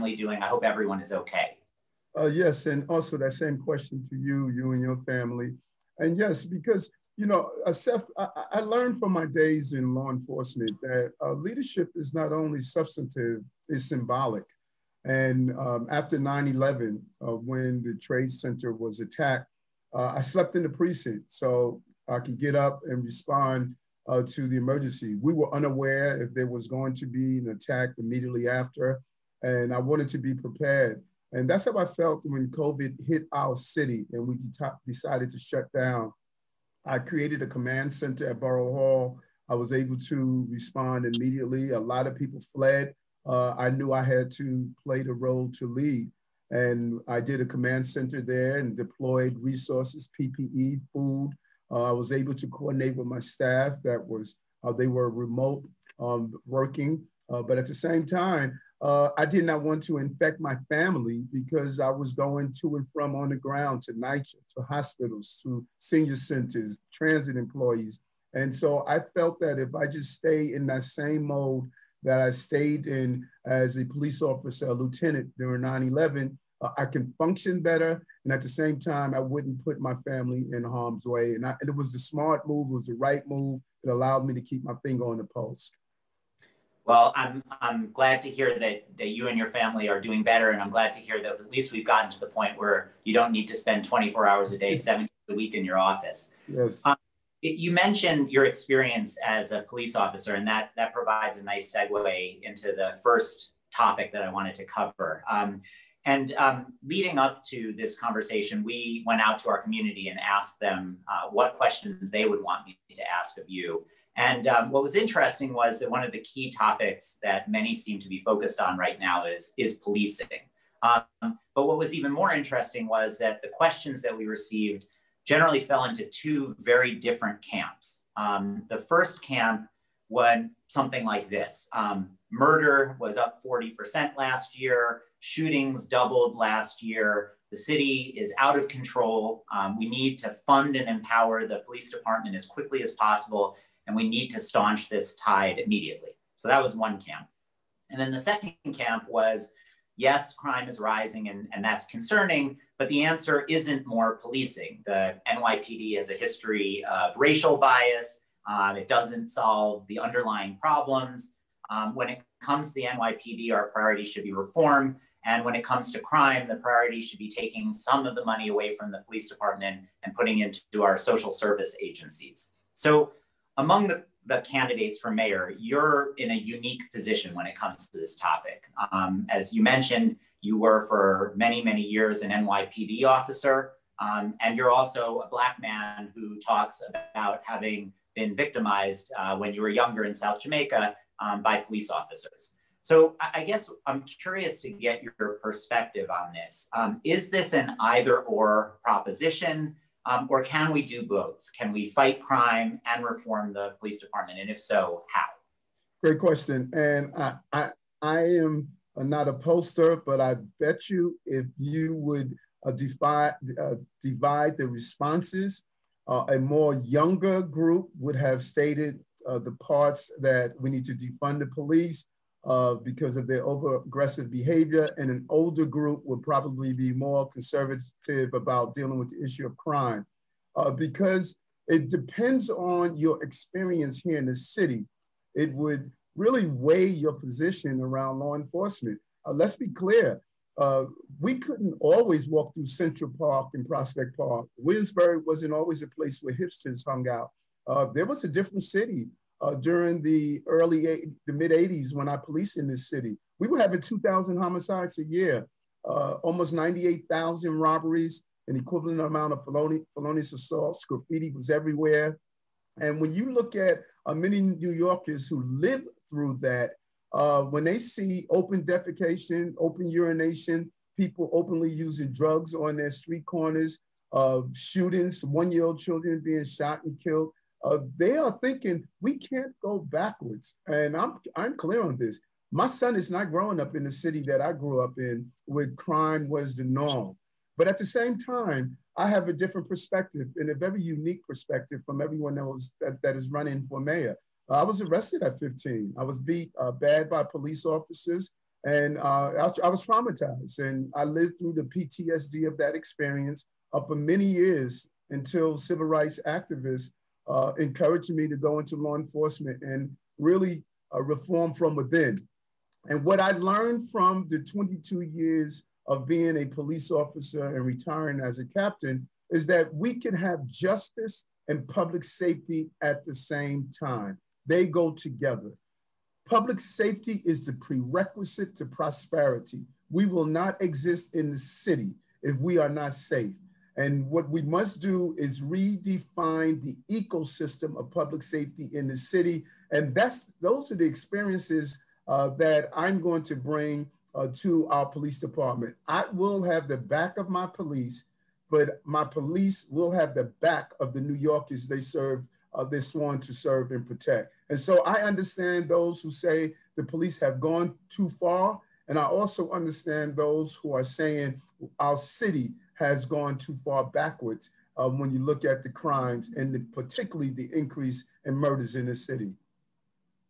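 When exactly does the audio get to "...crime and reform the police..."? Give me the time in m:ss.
3:22.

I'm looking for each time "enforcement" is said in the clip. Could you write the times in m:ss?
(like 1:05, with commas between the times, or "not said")
0:10, 3:58, 5:08.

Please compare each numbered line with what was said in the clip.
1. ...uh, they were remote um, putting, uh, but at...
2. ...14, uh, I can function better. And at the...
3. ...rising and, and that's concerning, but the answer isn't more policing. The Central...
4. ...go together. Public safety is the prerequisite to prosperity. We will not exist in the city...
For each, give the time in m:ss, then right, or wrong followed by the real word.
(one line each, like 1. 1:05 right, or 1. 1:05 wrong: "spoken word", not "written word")
1. 0:54 wrong: "working", not "putting"
2. 1:15 wrong: "11", not "14"
3. 2:30 wrong: "NYPD", not "Central"
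4. 5:24 right.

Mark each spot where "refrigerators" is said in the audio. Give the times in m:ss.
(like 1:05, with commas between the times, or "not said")
not said.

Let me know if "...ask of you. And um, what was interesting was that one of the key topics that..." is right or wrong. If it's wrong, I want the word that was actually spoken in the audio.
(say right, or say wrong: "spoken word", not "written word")
right.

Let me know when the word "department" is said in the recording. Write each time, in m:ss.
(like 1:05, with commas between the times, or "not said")
2:21, 2:49, 3:23, 5:45.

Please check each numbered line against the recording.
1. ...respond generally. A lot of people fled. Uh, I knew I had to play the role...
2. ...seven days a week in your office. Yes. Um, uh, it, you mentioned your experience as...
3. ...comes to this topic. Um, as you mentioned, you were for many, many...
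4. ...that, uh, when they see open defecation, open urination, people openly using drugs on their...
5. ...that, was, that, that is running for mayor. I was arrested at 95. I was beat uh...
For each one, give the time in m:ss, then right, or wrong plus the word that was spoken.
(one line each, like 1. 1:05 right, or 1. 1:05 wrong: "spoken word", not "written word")
1. 0:40 wrong: "immediately", not "generally"
2. 1:34 right
3. 2:57 right
4. 4:26 right
5. 4:52 wrong: "15", not "95".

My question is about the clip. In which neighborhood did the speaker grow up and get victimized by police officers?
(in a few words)
South Jamaica.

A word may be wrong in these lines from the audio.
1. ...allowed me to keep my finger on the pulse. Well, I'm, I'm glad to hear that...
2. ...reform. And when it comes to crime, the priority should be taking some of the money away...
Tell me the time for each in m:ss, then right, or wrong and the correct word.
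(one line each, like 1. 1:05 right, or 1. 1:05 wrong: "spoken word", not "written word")
1. 1:23 right
2. 2:44 right.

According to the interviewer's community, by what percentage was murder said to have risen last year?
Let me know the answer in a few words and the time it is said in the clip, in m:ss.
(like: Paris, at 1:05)
40%, at 2:13.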